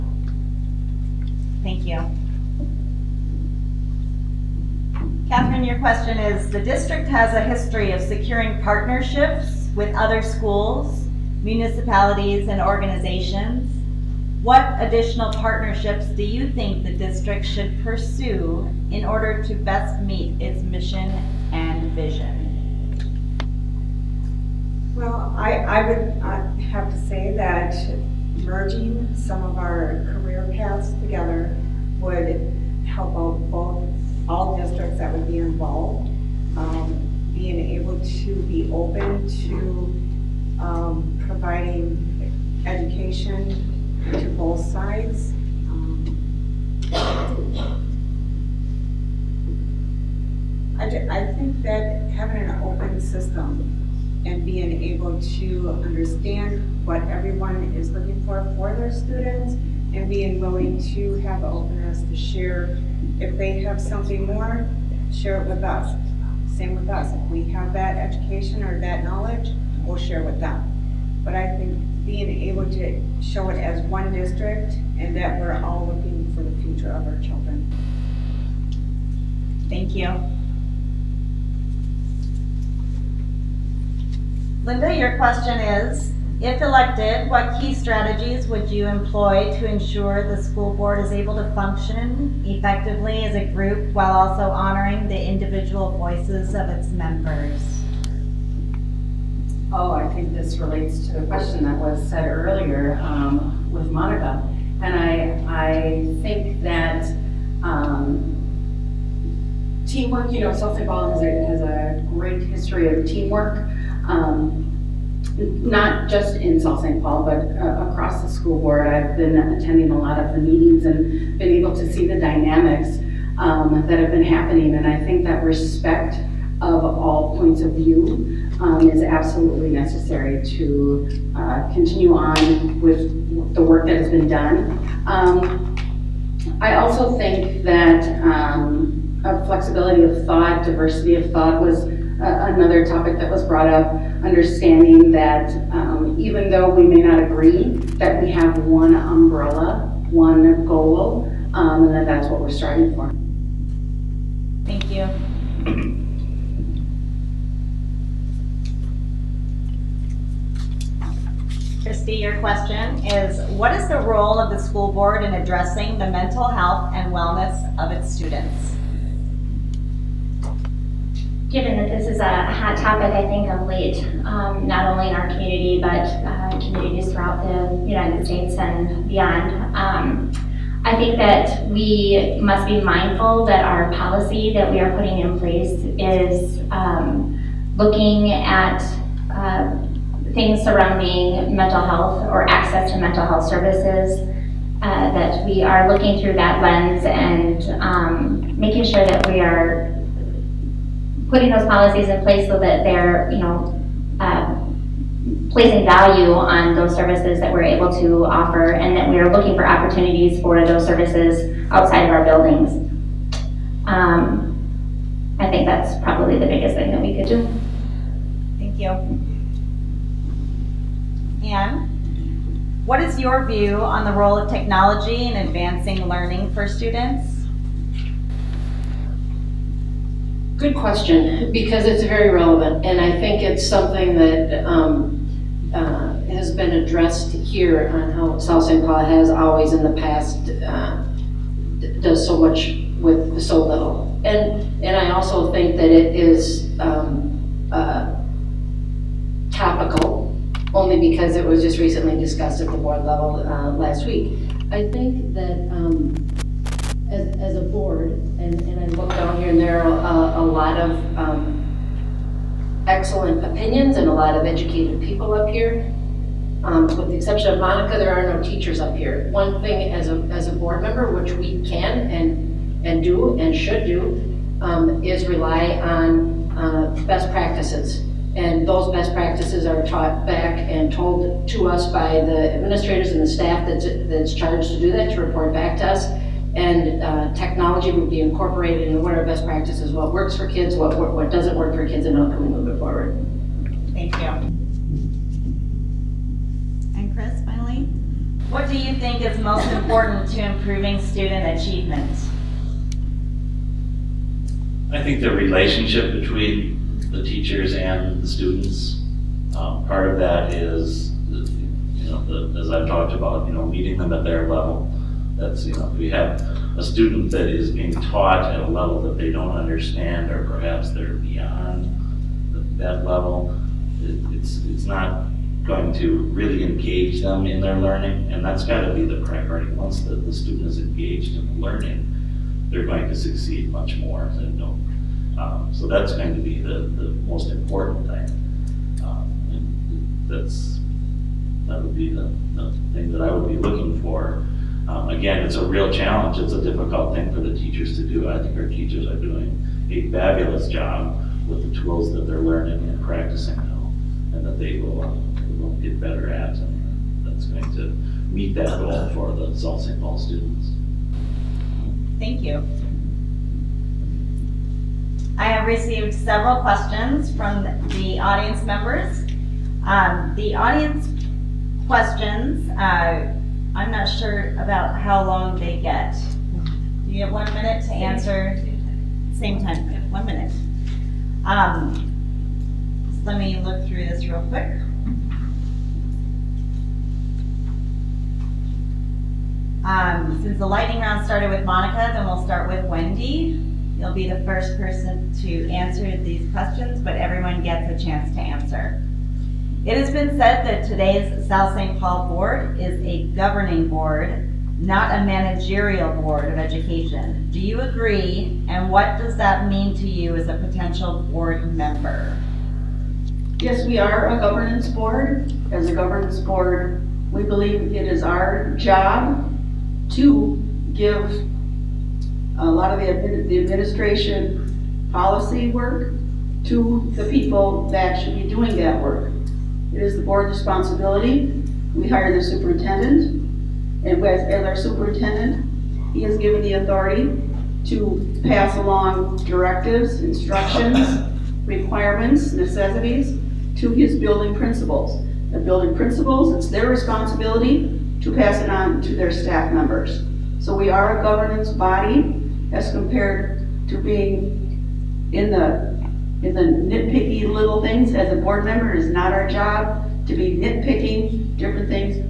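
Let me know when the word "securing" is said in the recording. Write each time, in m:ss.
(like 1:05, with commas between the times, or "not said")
0:08.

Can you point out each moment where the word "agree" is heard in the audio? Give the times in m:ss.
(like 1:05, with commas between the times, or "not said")
2:27, 6:47.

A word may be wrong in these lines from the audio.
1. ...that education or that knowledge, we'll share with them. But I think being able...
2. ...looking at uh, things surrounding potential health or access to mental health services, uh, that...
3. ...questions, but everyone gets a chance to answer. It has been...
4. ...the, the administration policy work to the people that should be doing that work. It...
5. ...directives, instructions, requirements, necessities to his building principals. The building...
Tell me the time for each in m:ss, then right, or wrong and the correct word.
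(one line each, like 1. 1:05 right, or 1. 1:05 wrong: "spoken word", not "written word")
1. 1:07 right
2. 3:07 wrong: "mental", not "potential"
3. 6:36 right
4. 7:03 right
5. 7:19 right.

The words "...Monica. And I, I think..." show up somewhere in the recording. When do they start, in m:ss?
1:43.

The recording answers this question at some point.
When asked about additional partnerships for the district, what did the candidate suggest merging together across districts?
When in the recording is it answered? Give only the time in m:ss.
0:30.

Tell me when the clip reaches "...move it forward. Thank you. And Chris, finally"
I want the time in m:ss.
4:52.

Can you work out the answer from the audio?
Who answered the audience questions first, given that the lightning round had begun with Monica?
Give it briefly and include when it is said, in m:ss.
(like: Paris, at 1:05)
Wendy, at 6:32.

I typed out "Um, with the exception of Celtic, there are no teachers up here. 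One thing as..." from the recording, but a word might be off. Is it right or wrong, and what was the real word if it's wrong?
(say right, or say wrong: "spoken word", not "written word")
wrong: "Monica", not "Celtic".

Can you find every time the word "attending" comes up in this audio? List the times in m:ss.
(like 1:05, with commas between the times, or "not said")
1:59.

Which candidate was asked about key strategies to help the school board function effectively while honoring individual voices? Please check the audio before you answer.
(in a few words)
Linda.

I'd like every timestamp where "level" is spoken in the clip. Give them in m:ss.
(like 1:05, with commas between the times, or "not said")
4:13, 5:14, 5:18, 5:23.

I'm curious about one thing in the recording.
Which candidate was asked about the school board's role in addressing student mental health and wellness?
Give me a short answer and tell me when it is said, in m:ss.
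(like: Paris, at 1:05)
Christy, at 2:41.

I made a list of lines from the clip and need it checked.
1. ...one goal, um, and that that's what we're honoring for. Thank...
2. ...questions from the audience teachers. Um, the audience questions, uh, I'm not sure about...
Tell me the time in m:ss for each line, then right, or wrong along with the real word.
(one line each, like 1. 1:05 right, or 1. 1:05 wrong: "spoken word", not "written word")
1. 2:30 wrong: "striving", not "honoring"
2. 6:06 wrong: "members", not "teachers".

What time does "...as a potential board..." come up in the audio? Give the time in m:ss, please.
6:50.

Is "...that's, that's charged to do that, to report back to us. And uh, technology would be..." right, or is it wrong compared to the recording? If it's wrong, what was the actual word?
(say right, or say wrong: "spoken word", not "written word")
right.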